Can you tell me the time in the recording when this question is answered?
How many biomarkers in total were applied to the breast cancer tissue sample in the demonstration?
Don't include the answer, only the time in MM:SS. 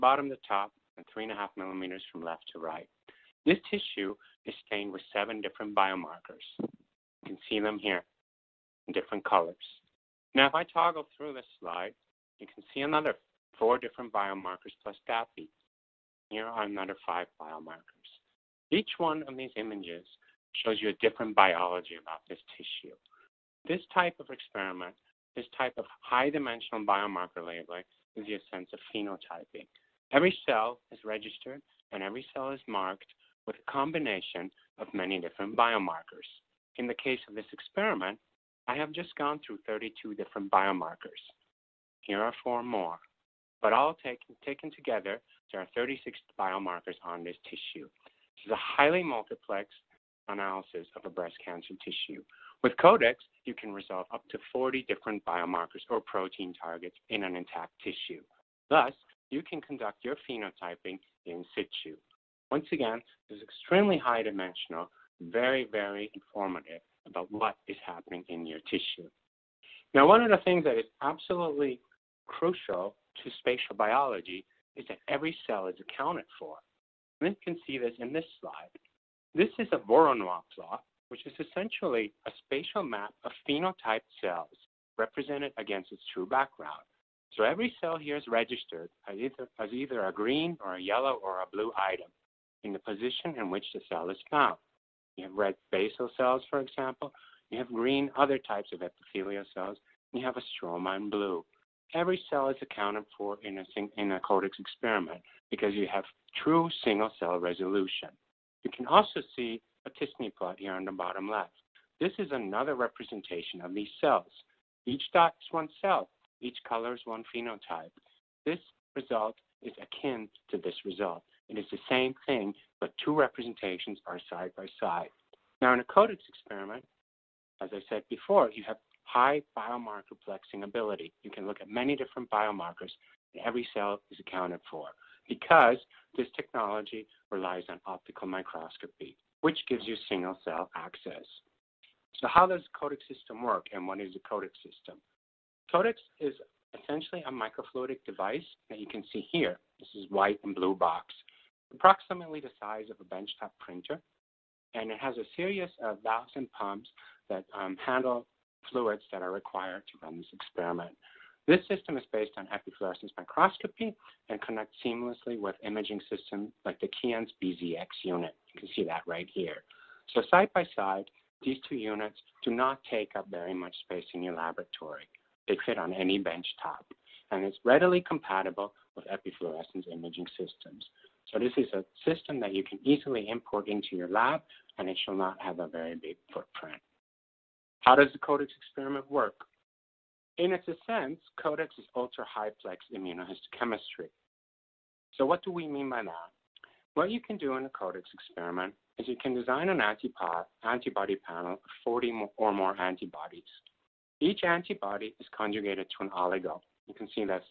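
00:45.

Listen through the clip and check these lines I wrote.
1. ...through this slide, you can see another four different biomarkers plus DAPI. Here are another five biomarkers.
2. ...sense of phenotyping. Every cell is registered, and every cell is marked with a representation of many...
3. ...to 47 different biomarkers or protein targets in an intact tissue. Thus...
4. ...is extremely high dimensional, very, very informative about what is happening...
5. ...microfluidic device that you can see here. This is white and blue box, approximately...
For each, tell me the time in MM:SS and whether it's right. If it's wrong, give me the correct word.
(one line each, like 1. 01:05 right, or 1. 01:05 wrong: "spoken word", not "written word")
1. 00:11 right
2. 00:28 wrong: "combination", not "representation"
3. 00:54 wrong: "40", not "47"
4. 01:03 right
5. 02:27 right.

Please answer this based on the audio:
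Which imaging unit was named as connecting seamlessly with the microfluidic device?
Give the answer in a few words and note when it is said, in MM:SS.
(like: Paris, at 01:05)
Keyence BZX, at 02:46.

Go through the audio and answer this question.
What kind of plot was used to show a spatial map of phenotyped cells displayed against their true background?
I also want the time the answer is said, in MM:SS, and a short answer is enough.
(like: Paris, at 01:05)
Voronoi plot, at 01:19.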